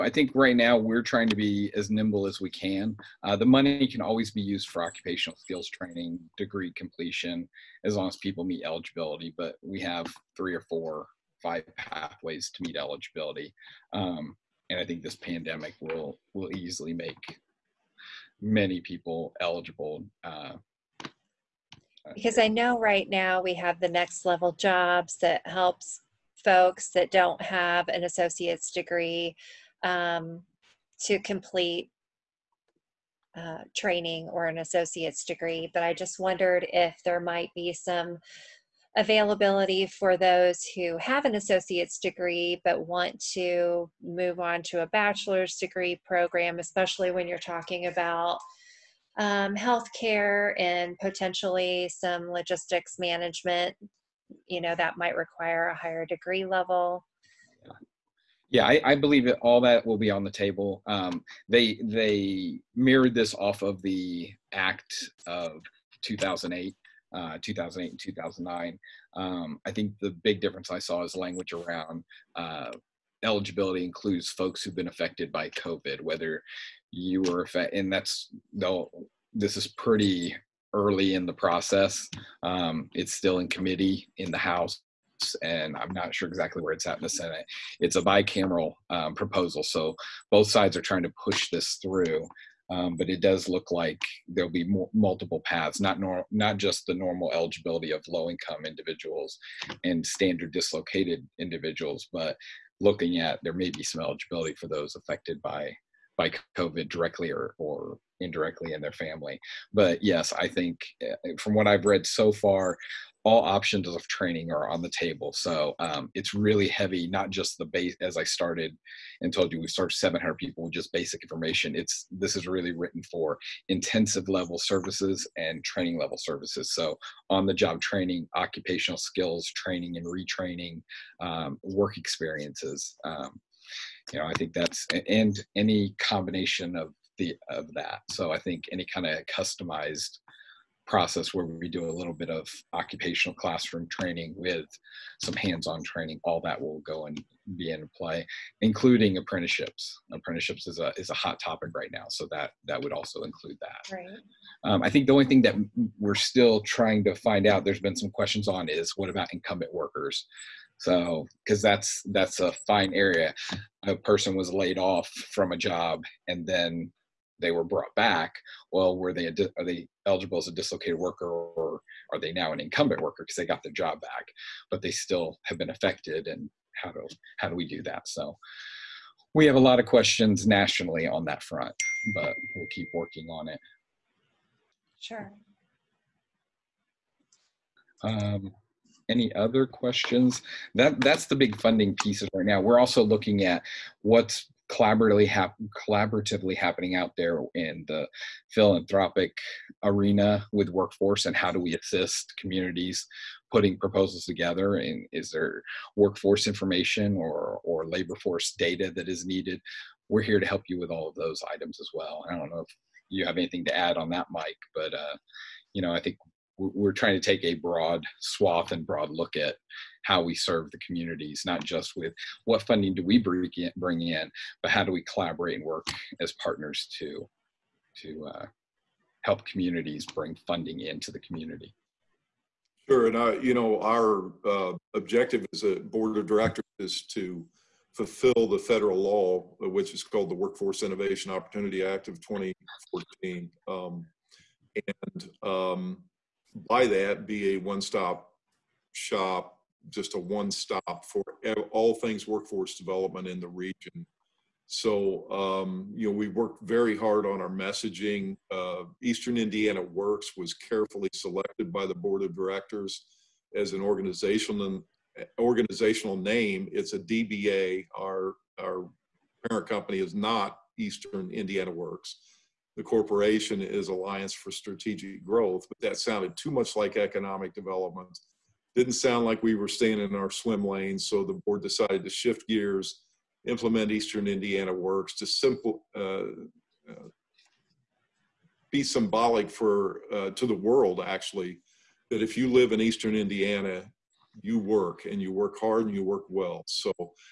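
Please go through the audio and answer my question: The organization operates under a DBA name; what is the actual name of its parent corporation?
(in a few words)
Alliance for Strategic Growth.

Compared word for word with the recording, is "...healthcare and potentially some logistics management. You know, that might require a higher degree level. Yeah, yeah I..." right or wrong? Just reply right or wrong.
right.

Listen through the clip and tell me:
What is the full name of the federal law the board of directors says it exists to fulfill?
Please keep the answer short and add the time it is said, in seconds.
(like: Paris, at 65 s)
Workforce Innovation Opportunity Act of 2014, at 240 s.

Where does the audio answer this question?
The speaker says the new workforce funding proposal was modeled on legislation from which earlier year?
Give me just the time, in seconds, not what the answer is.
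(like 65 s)
64 s.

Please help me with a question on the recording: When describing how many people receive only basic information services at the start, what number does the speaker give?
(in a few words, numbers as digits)
700.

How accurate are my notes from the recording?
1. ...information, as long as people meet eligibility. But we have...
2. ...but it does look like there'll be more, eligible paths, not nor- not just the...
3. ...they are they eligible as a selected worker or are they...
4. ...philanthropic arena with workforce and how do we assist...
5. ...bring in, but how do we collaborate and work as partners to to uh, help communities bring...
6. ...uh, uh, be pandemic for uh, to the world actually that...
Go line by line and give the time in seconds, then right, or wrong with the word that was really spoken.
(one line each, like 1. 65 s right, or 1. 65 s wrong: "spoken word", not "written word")
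1. 6 s wrong: "completion", not "information"
2. 92 s wrong: "multiple", not "eligible"
3. 169 s wrong: "dislocated", not "selected"
4. 198 s right
5. 223 s right
6. 285 s wrong: "symbolic", not "pandemic".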